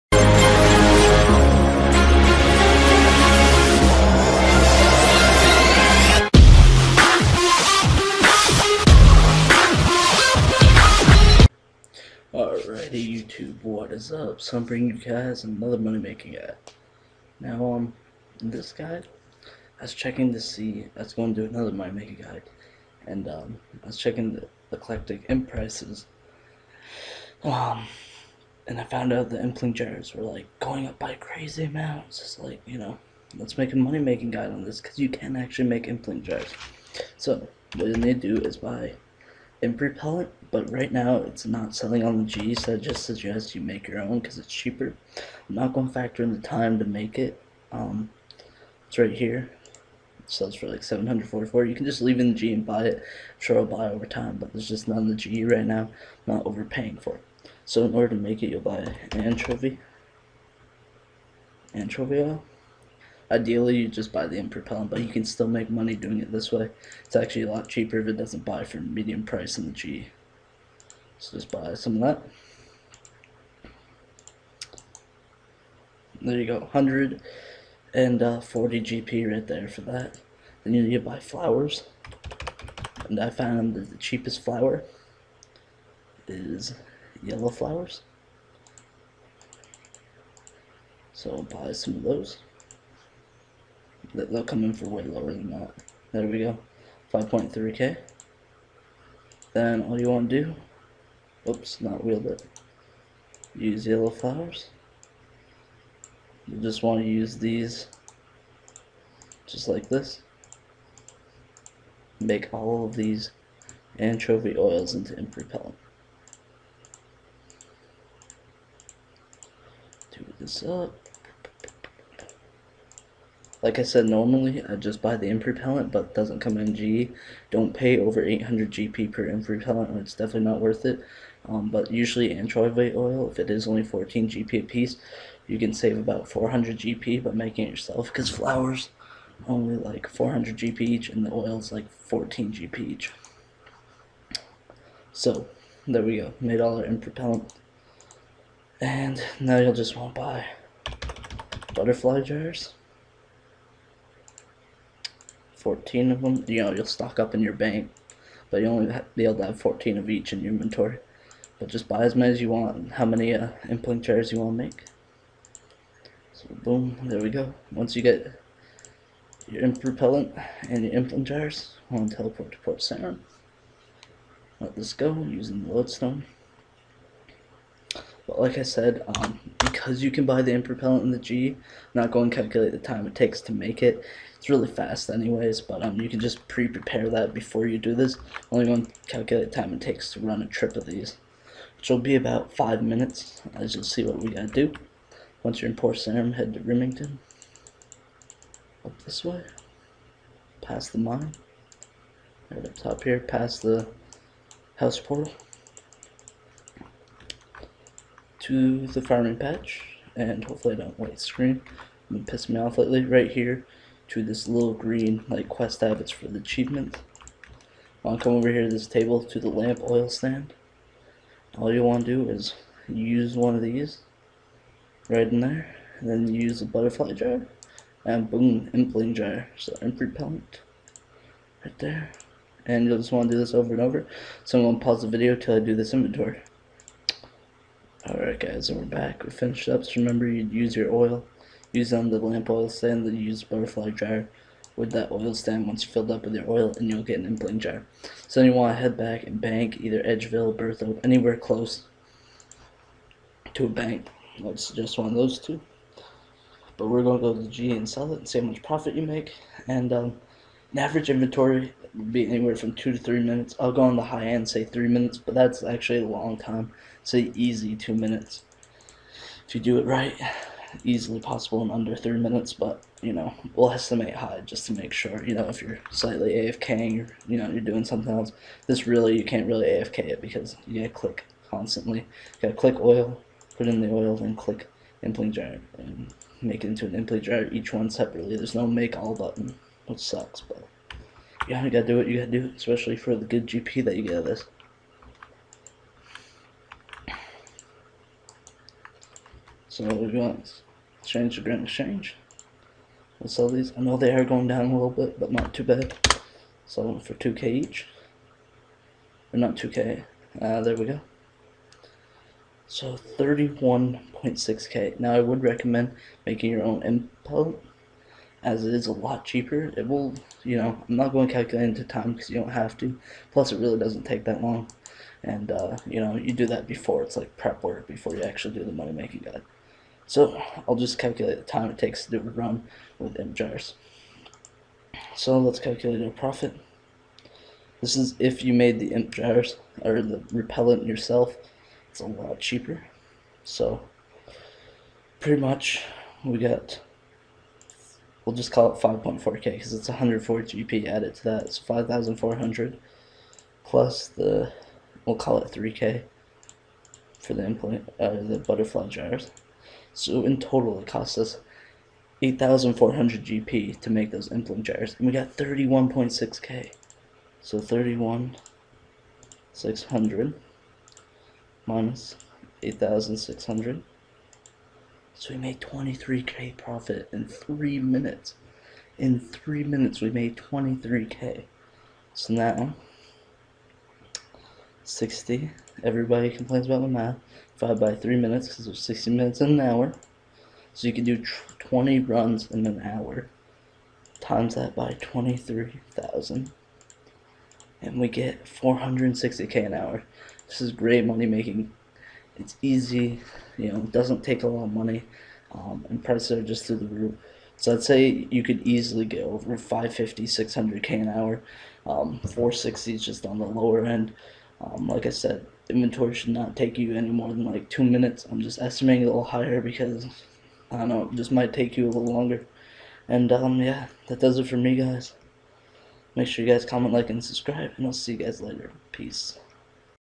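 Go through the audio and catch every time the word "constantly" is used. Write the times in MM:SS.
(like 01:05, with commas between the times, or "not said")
04:41.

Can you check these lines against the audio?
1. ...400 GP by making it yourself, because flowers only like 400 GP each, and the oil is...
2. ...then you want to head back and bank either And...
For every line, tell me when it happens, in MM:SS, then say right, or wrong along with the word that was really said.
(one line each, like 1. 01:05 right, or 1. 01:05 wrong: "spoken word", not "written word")
1. 02:16 right
2. 04:08 wrong: "Edgeville", not "And".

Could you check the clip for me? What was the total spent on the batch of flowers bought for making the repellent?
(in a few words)
5.3k.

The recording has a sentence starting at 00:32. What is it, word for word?
It's like, you know, let's make a money making guide on this because you can actually make impling jars.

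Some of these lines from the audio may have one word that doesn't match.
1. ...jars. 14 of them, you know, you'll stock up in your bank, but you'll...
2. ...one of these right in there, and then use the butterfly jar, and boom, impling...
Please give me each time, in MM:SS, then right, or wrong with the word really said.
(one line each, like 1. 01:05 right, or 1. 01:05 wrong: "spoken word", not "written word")
1. 02:32 right
2. 03:43 right.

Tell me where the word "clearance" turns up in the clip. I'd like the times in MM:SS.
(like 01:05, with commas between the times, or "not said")
not said.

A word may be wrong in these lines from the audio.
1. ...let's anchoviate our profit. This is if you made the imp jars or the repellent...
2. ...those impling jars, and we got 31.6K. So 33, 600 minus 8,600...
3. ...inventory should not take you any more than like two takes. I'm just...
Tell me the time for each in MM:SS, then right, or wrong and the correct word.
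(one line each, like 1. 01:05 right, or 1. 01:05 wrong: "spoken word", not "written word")
1. 05:35 wrong: "calculate", not "anchoviate"
2. 06:04 wrong: "31", not "33"
3. 06:55 wrong: "minutes", not "takes".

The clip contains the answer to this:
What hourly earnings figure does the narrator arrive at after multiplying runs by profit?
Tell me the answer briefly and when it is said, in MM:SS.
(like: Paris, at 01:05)
460k, at 06:38.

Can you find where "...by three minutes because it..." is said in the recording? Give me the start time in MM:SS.
06:27.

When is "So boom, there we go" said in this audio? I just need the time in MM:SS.
02:46.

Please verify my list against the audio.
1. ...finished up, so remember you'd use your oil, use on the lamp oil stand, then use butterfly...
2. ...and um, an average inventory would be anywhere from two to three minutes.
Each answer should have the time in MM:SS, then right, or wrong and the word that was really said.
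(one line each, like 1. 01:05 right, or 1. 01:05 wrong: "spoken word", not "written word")
1. 03:59 right
2. 04:19 right.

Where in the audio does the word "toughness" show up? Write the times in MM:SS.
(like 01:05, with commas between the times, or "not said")
not said.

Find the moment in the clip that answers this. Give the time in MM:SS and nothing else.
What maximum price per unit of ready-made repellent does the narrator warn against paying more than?
02:08.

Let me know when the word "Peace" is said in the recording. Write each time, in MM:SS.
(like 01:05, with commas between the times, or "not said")
07:08.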